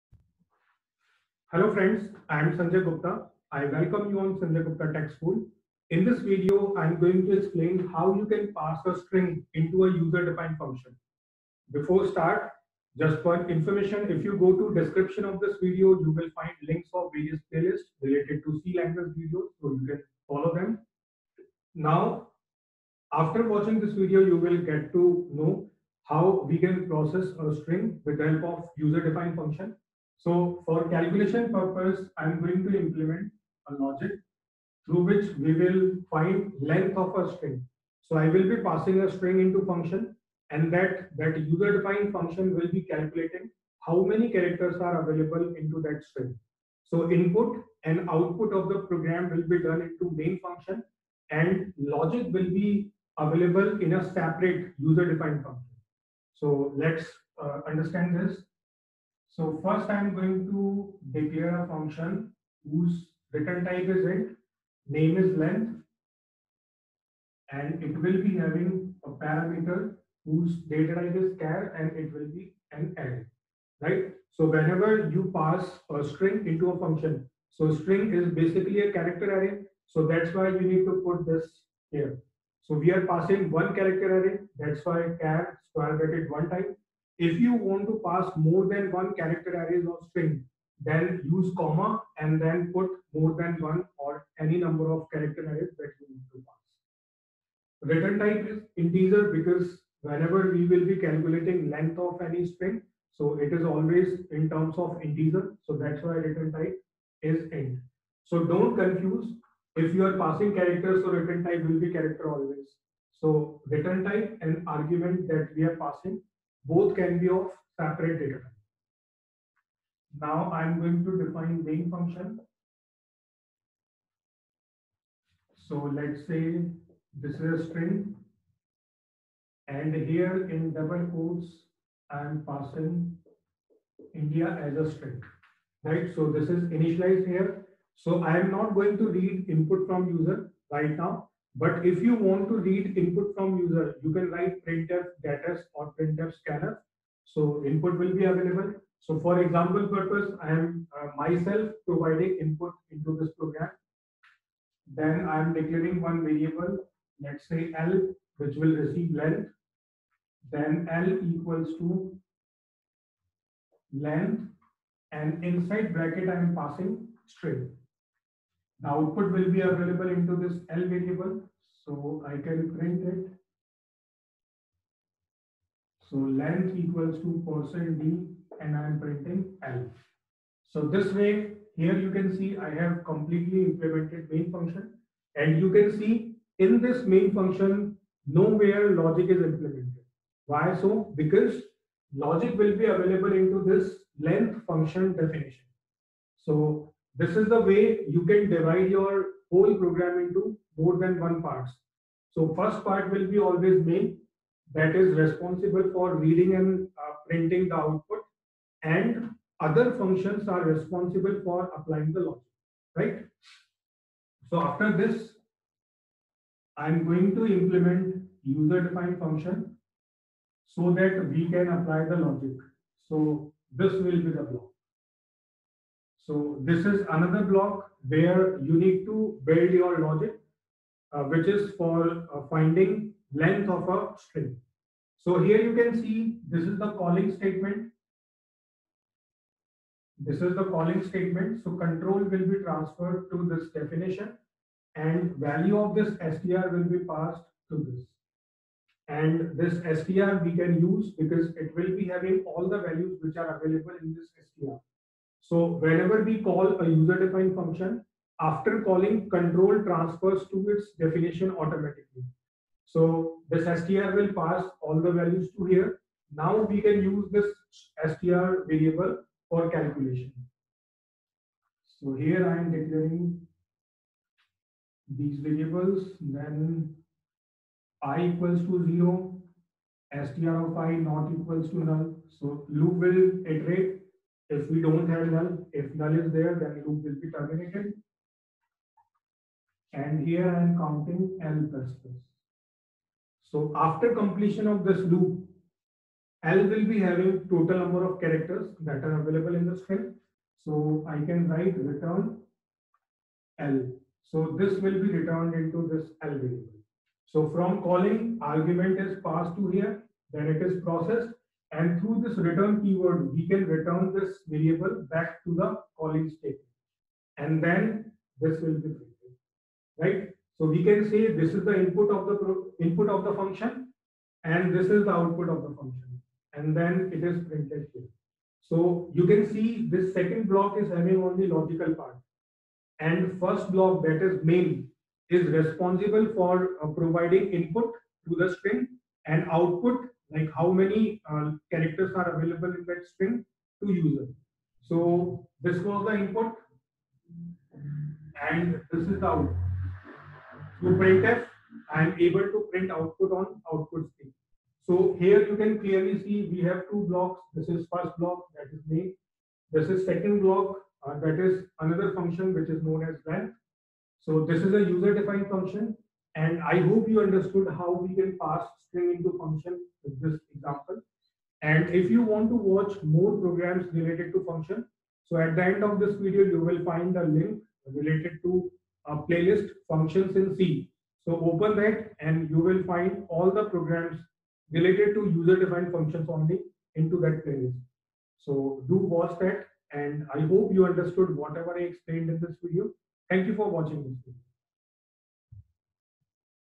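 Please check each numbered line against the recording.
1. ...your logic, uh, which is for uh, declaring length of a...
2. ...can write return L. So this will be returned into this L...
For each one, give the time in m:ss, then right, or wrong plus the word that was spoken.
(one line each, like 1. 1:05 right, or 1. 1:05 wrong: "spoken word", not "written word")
1. 3:49 wrong: "finding", not "declaring"
2. 5:01 right.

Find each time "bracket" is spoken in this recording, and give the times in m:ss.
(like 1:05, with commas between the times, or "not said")
1:25, 2:45.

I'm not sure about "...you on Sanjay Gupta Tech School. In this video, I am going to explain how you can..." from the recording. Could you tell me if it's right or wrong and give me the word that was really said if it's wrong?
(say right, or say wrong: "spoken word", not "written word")
right.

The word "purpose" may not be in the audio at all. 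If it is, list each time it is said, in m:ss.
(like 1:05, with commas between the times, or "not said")
0:31, 2:29.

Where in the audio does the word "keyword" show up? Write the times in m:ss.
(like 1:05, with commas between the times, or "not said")
5:12.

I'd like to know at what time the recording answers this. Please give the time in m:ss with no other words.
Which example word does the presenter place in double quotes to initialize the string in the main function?
2:14.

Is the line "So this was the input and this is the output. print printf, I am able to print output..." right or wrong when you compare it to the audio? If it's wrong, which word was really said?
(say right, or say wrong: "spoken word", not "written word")
right.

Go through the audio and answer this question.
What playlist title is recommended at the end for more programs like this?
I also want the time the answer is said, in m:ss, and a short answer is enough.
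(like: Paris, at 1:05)
functions in C, at 6:19.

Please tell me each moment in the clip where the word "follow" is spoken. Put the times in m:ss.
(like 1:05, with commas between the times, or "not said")
0:20.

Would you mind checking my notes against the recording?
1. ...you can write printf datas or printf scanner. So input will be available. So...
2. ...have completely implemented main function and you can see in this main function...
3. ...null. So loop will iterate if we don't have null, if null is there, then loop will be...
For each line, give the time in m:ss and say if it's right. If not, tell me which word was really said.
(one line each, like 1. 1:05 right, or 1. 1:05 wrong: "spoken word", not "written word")
1. 2:24 right
2. 3:02 right
3. 4:41 right.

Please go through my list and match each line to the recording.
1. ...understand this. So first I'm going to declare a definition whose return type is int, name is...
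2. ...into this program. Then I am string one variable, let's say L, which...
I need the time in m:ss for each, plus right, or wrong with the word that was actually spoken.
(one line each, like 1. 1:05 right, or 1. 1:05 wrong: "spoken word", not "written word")
1. 0:57 wrong: "function", not "definition"
2. 2:32 wrong: "declaring", not "string".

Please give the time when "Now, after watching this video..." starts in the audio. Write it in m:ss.
0:21.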